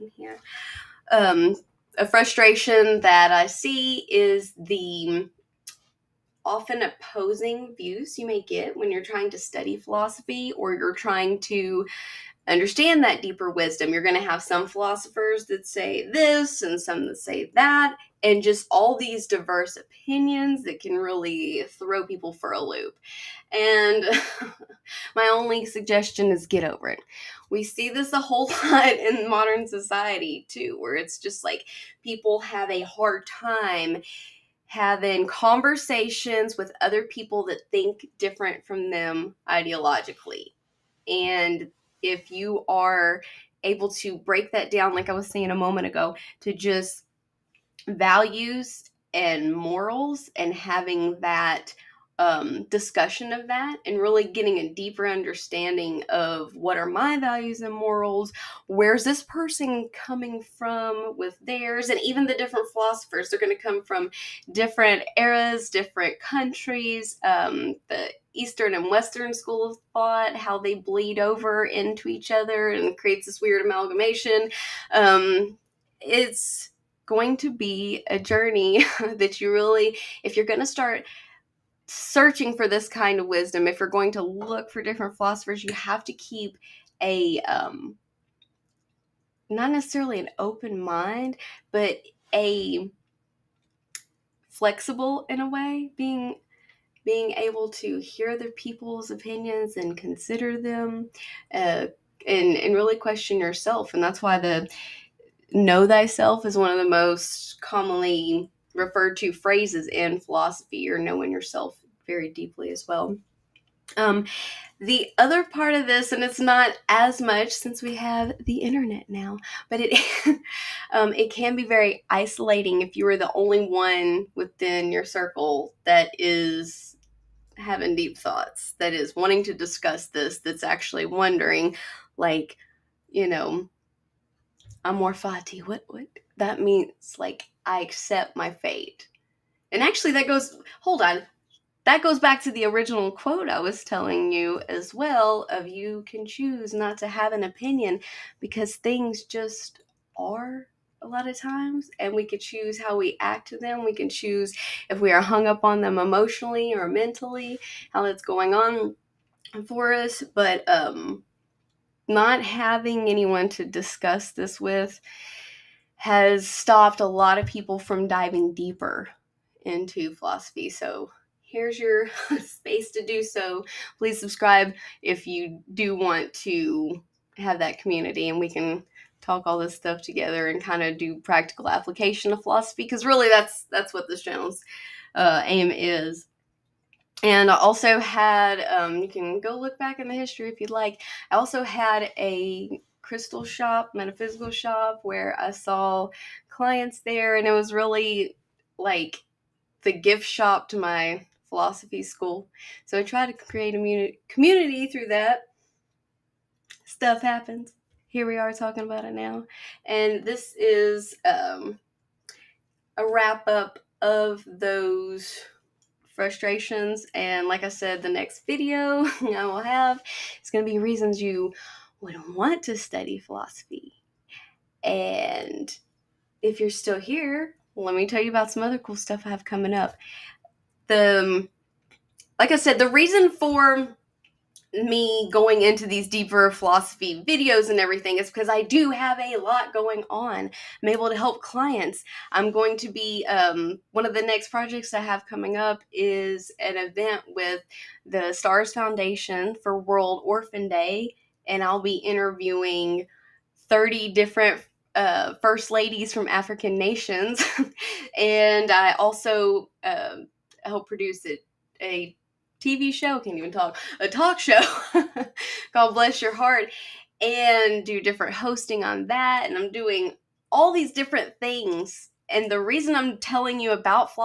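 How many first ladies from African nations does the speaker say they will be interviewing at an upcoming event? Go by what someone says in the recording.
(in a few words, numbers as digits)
30.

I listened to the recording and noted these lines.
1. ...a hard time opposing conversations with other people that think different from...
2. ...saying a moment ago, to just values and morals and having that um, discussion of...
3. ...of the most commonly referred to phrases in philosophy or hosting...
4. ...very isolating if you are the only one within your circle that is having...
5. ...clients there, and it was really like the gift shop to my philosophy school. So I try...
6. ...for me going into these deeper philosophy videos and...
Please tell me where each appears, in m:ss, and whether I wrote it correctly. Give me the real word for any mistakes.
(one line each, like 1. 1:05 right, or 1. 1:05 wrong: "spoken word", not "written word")
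1. 0:32 wrong: "having", not "opposing"
2. 0:45 right
3. 1:46 wrong: "knowing", not "hosting"
4. 2:01 right
5. 3:16 right
6. 3:53 right.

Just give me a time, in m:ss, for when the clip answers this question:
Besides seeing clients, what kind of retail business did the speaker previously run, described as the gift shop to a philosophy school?
3:13.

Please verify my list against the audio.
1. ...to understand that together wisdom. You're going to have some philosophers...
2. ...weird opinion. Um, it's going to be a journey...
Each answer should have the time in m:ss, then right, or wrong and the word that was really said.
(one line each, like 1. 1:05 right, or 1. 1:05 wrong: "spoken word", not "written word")
1. 0:11 wrong: "deeper", not "together"
2. 1:13 wrong: "amalgamation", not "opinion".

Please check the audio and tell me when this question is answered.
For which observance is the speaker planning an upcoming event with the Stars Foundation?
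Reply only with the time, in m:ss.
4:09.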